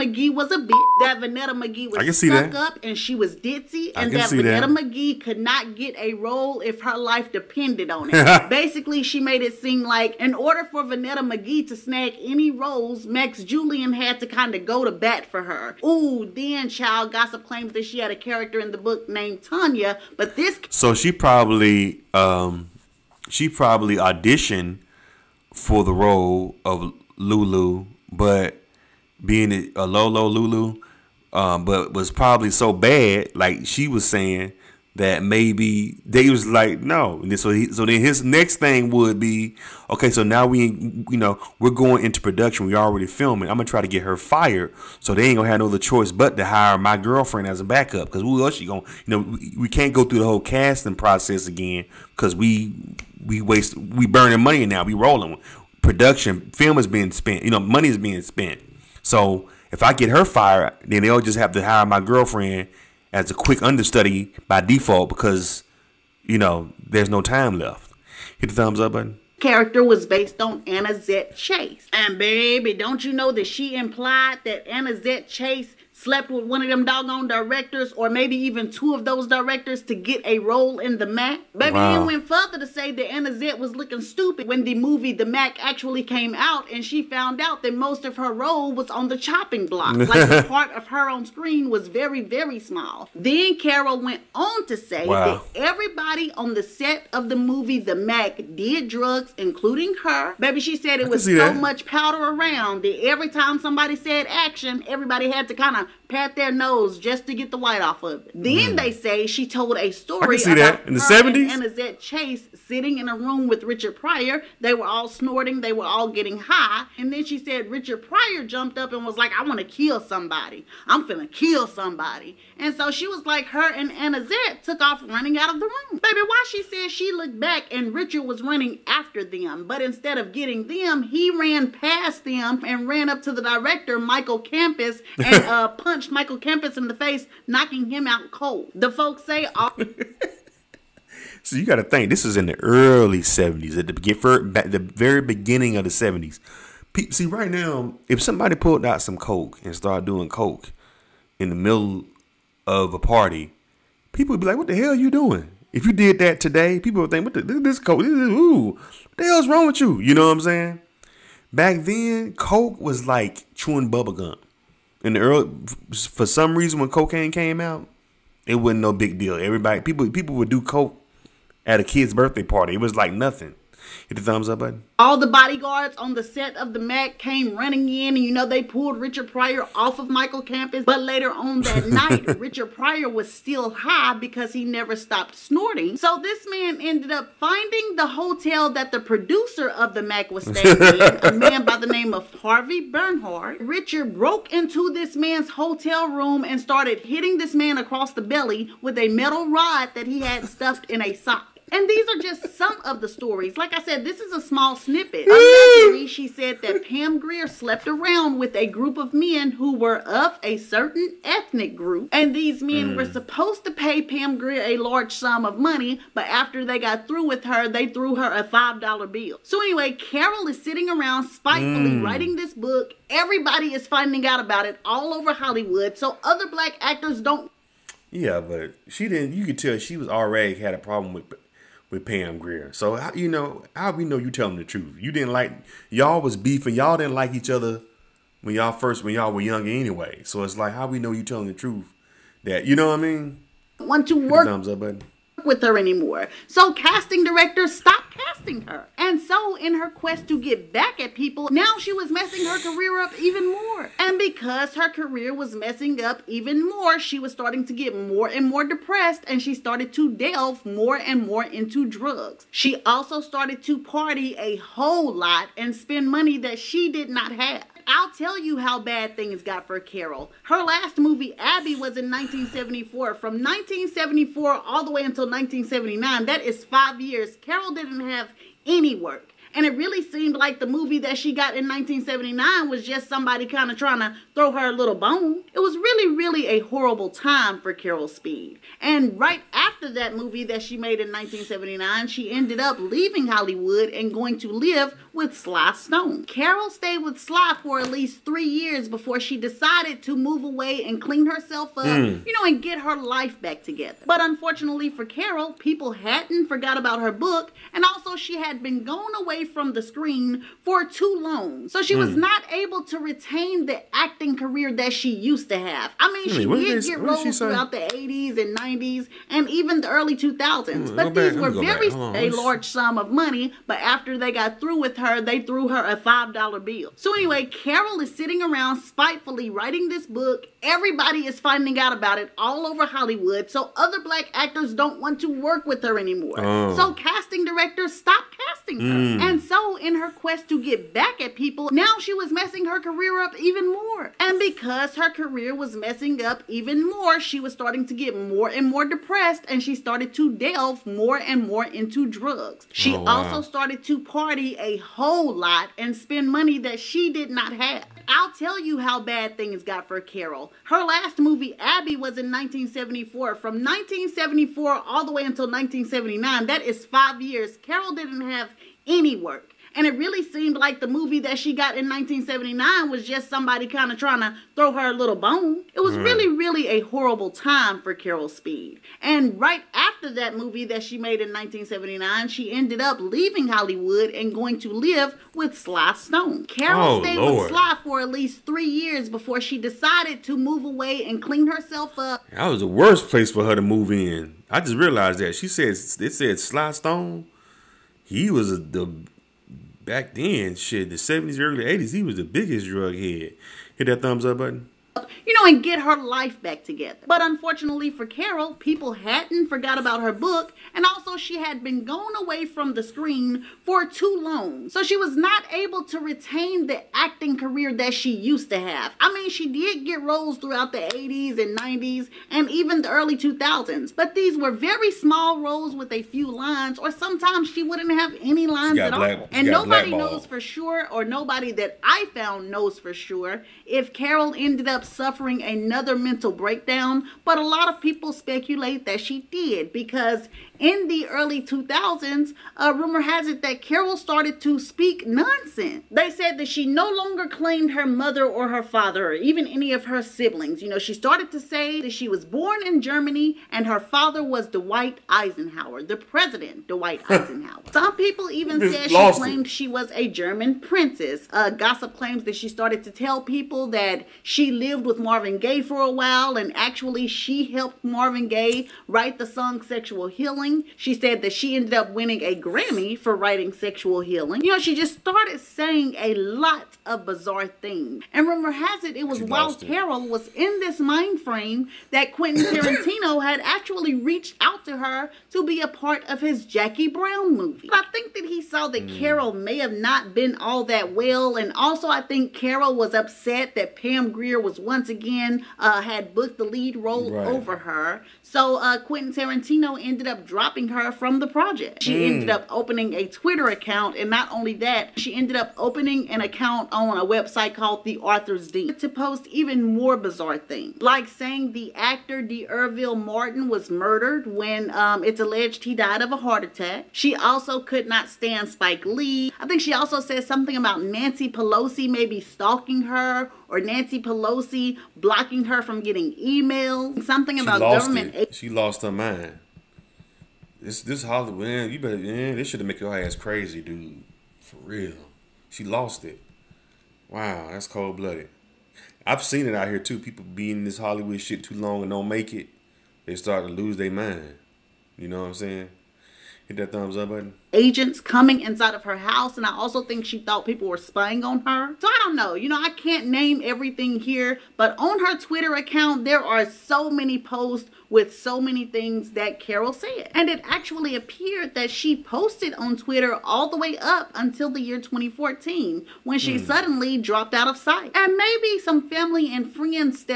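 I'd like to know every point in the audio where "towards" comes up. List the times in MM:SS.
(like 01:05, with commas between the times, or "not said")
not said.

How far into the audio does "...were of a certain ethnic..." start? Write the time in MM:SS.
03:29.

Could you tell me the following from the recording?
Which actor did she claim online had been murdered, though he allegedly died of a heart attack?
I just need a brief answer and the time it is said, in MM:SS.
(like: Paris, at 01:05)
D'Urville Martin, at 08:32.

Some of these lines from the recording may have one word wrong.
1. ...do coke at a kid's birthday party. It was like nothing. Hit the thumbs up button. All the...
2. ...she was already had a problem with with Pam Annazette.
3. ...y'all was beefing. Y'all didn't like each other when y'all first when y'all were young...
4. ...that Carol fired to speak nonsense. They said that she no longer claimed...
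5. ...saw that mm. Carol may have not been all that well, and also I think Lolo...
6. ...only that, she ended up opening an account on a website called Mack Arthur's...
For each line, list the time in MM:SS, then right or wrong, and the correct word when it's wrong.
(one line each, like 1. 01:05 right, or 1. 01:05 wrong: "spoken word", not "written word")
1. 02:50 right
2. 03:49 wrong: "Grier", not "Annazette"
3. 03:55 right
4. 07:23 wrong: "started", not "fired"
5. 08:08 wrong: "Carol", not "Lolo"
6. 08:24 wrong: "The", not "Mack".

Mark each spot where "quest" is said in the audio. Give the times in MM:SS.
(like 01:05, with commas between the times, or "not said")
04:09, 05:40.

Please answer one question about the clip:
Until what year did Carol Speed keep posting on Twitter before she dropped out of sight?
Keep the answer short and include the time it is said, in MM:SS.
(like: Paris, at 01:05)
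2014, at 09:24.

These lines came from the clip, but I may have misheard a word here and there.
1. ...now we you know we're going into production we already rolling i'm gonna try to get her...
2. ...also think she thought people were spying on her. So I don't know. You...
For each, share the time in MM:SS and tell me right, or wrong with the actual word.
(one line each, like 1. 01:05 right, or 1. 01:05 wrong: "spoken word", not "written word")
1. 00:40 wrong: "filming", not "rolling"
2. 09:09 right.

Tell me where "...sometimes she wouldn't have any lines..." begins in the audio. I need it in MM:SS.
07:06.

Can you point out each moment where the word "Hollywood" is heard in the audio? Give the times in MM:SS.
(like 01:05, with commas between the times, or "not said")
03:45, 04:53, 05:32, 06:23, 08:51, 09:00.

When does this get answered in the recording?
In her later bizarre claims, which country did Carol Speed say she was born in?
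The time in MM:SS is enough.
07:32.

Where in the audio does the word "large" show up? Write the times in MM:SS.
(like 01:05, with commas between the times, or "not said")
03:34, 05:22.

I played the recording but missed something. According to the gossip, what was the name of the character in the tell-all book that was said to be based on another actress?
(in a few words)
Tanya.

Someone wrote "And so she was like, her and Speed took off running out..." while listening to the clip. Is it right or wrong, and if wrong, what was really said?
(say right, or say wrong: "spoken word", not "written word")
wrong: "Annazette", not "Speed".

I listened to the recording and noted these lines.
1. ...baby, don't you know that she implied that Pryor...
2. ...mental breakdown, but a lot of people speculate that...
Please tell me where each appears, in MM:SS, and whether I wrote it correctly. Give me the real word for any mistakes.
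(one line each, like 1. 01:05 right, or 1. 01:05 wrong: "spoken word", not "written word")
1. 01:12 wrong: "Annazette", not "Pryor"
2. 07:15 right.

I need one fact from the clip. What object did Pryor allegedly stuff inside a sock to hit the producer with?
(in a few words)
A metal rod.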